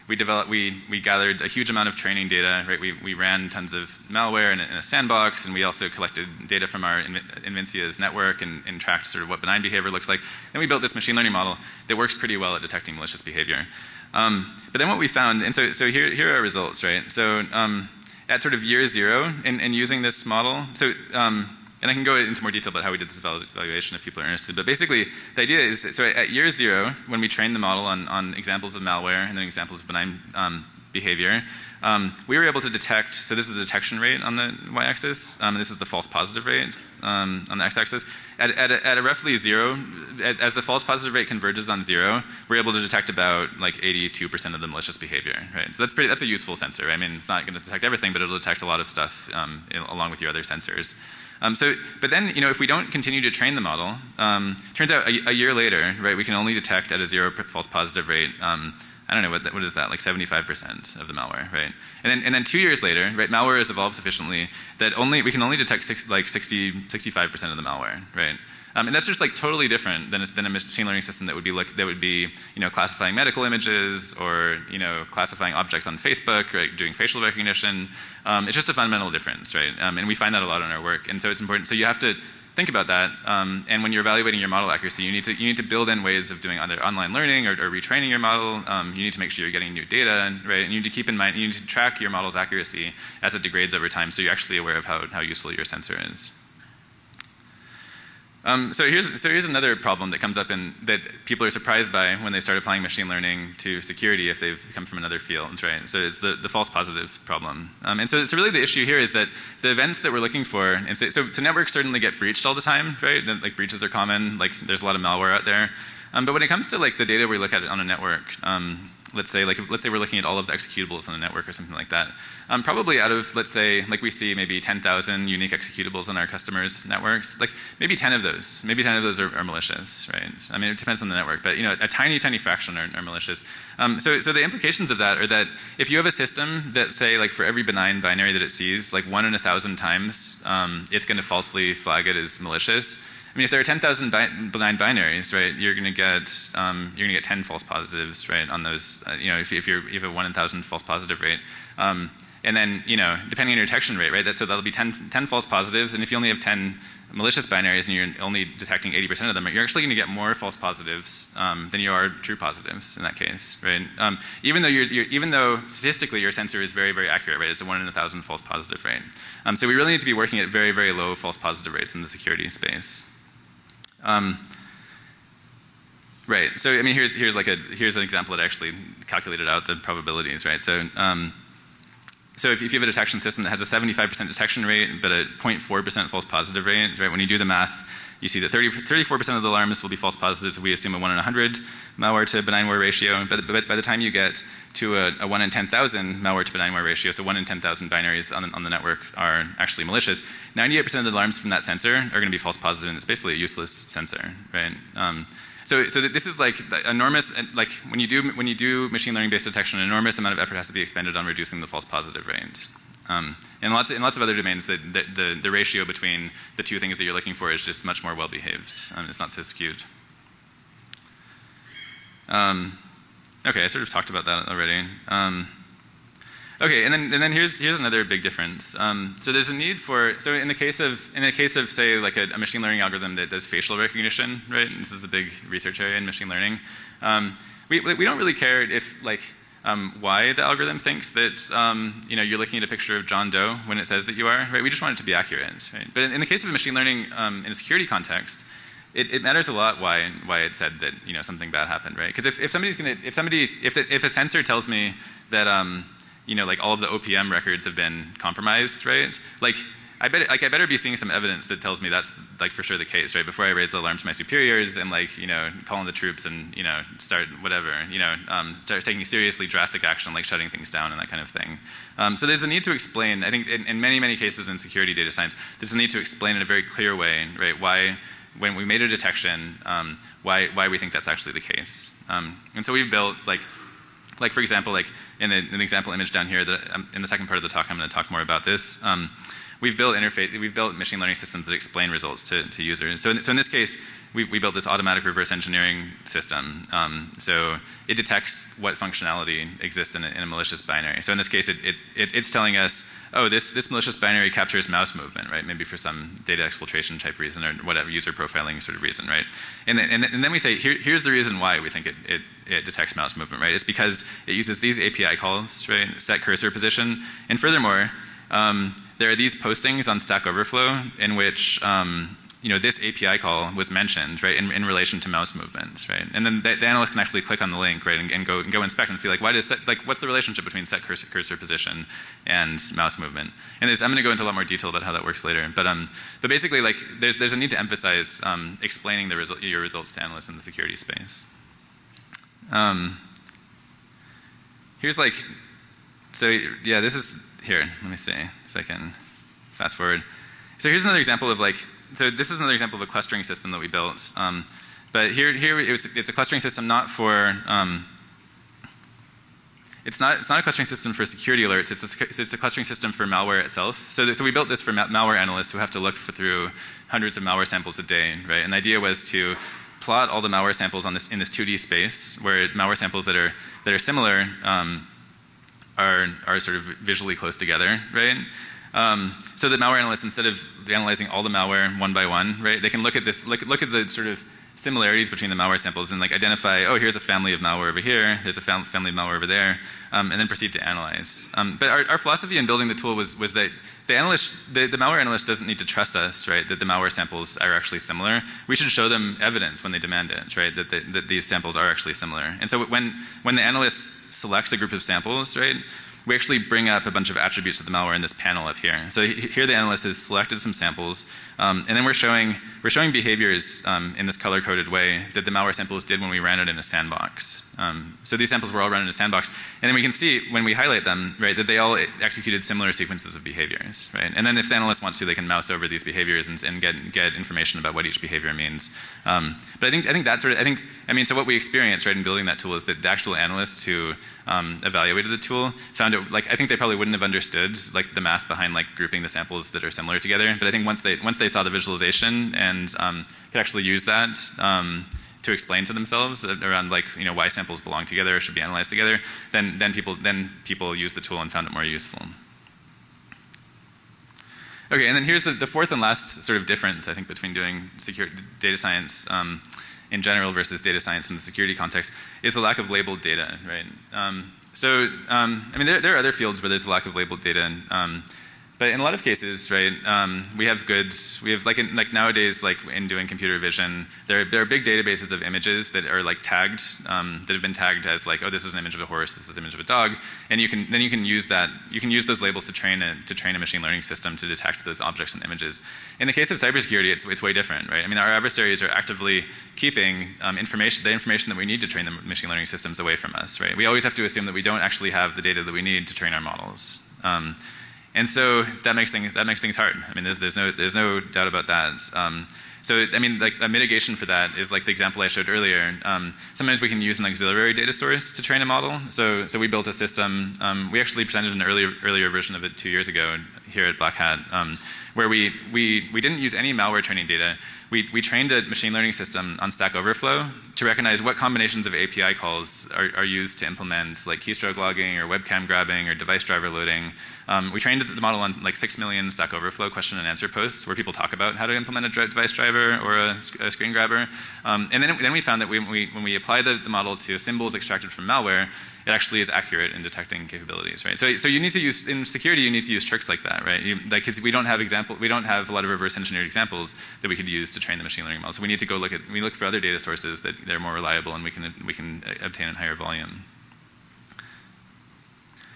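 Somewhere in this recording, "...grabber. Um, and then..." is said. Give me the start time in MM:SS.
08:53.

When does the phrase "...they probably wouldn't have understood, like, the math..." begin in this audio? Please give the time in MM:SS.
07:16.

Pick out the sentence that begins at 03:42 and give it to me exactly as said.
Um, Okay, I sort of talked about that already.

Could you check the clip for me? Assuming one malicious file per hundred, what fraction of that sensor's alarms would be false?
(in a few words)
34%.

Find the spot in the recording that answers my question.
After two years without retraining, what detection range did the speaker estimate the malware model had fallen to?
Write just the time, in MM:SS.
01:06.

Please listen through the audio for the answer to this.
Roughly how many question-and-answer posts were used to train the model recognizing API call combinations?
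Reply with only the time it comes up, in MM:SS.
08:48.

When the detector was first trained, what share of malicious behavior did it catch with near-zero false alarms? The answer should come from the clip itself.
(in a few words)
82%.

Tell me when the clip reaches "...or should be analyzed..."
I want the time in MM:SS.
07:28.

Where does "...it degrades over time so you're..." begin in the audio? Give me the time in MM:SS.
01:33.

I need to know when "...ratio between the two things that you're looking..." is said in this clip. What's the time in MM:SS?
03:35.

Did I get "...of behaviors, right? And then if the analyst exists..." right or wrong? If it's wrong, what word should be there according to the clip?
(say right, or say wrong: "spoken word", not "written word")
wrong: "wants", not "exists".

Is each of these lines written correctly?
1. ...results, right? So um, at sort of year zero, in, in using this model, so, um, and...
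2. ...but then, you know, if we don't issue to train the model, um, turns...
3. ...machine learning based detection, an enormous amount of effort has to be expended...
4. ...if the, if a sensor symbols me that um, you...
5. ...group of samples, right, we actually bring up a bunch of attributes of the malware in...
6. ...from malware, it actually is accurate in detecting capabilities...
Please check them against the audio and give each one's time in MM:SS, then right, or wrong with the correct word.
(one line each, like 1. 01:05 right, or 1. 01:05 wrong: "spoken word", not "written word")
1. 00:16 right
2. 00:52 wrong: "continue", not "issue"
3. 03:28 right
4. 04:13 wrong: "tells", not "symbols"
5. 06:44 right
6. 08:57 right.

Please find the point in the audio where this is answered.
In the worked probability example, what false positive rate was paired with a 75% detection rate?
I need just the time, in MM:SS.
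03:05.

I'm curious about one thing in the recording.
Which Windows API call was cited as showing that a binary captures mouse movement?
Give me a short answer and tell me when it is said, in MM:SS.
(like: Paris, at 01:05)
Set cursor position, at 05:16.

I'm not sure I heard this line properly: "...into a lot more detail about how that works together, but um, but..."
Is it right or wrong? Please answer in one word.
wrong.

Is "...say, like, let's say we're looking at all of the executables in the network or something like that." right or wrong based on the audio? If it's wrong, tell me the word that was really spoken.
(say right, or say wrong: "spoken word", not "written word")
right.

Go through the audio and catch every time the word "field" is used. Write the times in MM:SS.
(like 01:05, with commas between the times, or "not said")
01:45, 07:46.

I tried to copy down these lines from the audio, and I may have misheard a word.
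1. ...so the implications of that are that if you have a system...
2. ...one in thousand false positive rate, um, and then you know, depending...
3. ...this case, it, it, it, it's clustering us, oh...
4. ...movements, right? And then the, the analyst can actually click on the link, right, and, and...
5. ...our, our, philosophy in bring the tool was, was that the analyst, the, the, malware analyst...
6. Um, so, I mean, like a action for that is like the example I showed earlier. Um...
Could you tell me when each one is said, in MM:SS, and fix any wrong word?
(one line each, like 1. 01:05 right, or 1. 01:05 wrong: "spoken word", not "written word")
1. 02:14 right
2. 02:30 right
3. 05:01 wrong: "telling", not "clustering"
4. 05:25 right
5. 06:31 wrong: "building", not "bring"
6. 08:21 wrong: "mitigation", not "action".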